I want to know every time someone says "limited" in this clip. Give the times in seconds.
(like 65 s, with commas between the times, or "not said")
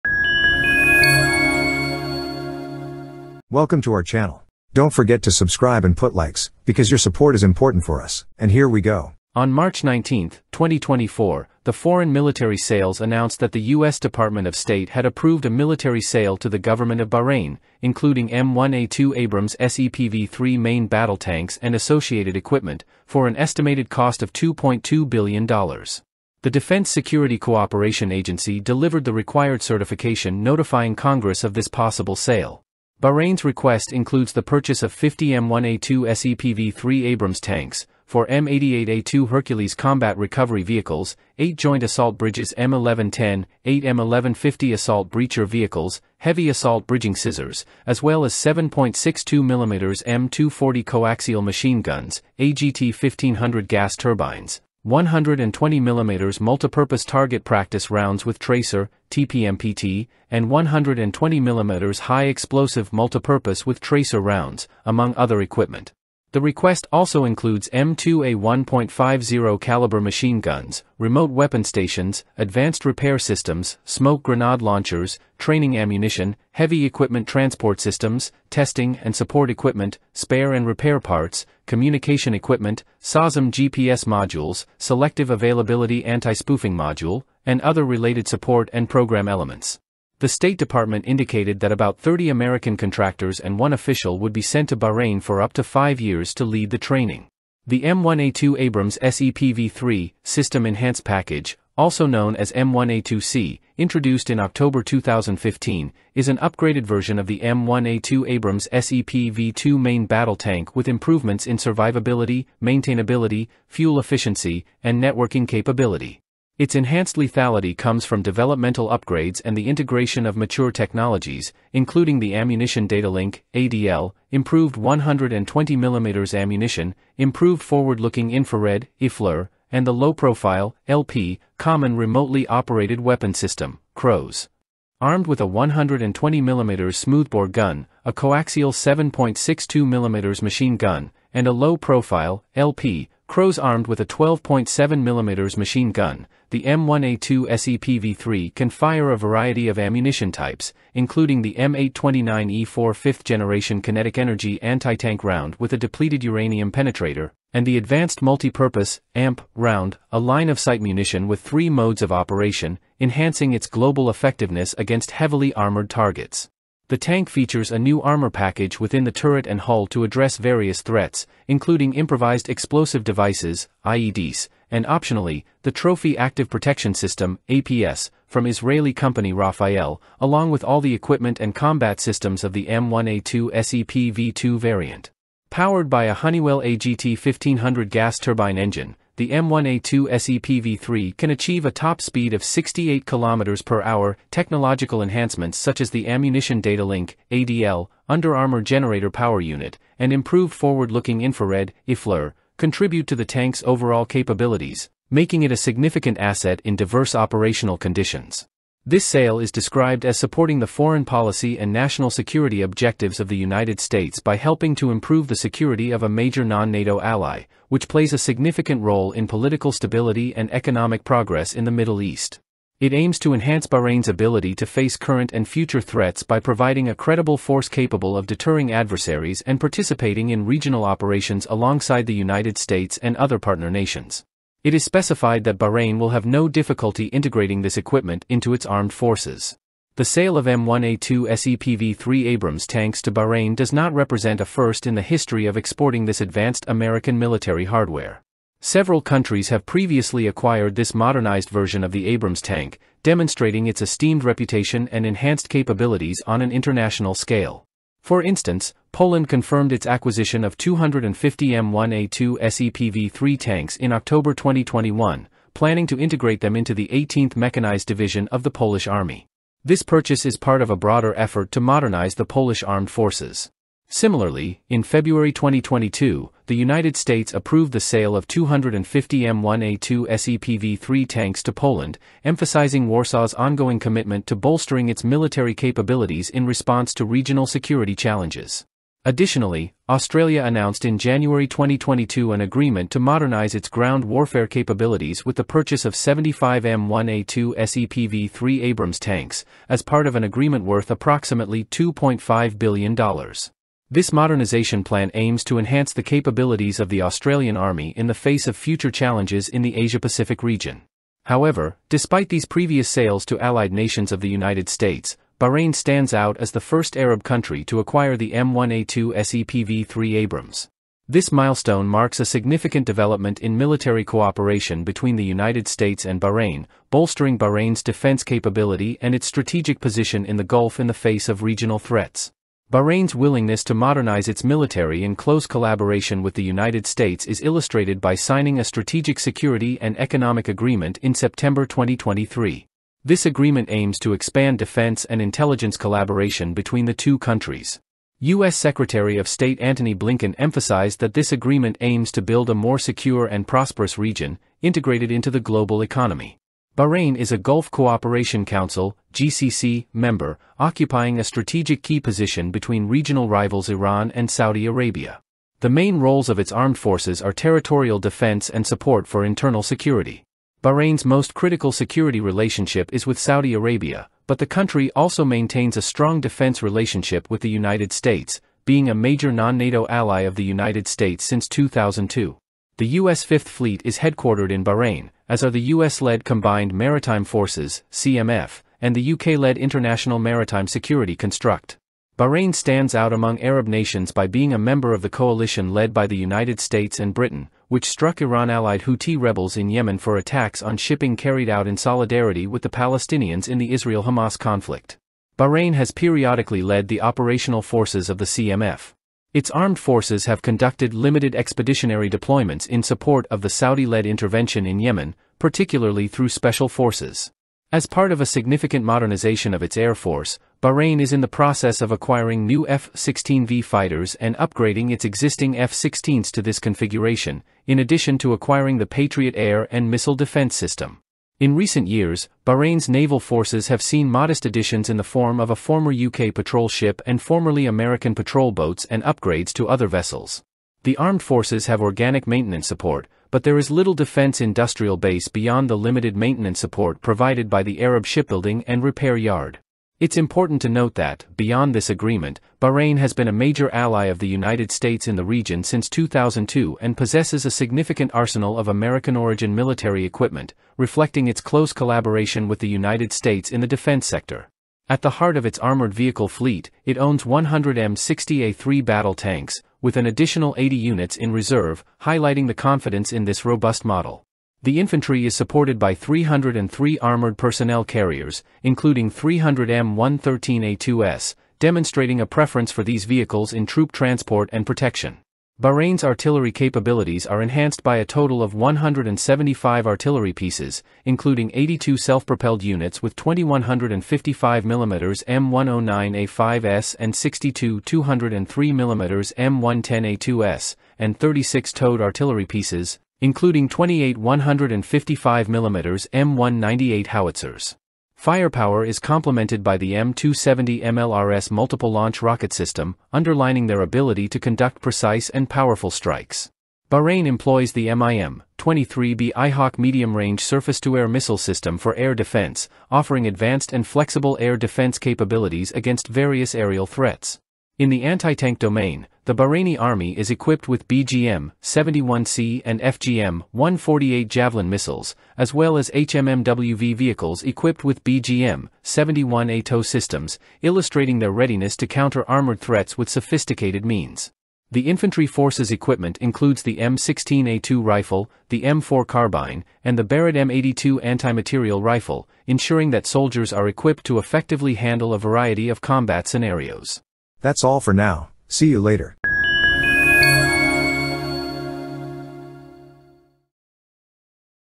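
410 s, 445 s.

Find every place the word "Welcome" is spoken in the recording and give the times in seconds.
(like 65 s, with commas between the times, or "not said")
3 s.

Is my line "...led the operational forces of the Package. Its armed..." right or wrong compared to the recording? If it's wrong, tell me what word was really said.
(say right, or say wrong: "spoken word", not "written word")
wrong: "CMF", not "Package".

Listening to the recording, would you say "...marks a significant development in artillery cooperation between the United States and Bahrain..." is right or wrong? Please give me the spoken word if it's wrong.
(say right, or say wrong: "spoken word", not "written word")
wrong: "military", not "artillery".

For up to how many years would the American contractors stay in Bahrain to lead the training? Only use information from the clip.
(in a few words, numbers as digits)
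five years.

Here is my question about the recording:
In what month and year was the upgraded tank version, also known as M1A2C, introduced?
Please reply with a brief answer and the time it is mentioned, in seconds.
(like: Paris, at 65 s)
October 2015, at 104 s.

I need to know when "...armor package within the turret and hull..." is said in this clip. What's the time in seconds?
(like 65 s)
168 s.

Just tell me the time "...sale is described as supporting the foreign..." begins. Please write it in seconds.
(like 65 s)
209 s.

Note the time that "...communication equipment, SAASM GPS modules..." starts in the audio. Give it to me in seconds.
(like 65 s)
81 s.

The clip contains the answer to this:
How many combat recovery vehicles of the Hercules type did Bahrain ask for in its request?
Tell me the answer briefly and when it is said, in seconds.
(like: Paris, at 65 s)
4, at 38 s.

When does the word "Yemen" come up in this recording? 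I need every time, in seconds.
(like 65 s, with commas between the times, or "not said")
399 s, 414 s.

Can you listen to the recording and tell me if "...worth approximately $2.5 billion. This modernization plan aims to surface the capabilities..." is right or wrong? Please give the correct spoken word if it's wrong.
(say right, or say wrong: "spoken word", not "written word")
wrong: "enhance", not "surface".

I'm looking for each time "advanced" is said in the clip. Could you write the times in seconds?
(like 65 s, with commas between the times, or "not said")
72 s, 157 s, 246 s, 523 s.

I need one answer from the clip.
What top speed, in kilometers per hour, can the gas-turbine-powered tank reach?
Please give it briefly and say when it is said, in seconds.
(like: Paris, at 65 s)
68 km/h, at 192 s.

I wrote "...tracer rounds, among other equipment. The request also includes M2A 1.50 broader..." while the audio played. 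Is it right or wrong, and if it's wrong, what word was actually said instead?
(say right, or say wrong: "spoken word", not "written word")
wrong: "caliber", not "broader".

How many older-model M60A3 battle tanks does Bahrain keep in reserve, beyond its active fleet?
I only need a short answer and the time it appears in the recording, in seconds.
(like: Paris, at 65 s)
80, at 470 s.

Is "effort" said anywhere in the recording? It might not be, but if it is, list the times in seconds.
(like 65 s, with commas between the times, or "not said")
271 s.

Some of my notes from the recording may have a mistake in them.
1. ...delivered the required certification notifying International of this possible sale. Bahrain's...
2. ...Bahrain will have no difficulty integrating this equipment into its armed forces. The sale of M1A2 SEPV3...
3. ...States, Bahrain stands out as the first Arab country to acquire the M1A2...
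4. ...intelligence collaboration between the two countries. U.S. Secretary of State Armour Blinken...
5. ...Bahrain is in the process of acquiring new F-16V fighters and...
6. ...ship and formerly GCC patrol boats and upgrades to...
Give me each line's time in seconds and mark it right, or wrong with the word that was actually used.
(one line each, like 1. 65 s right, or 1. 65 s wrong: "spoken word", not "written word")
1. 28 s wrong: "Congress", not "International"
2. 235 s right
3. 314 s right
4. 345 s wrong: "Antony", not "Armour"
5. 420 s right
6. 436 s wrong: "American", not "GCC".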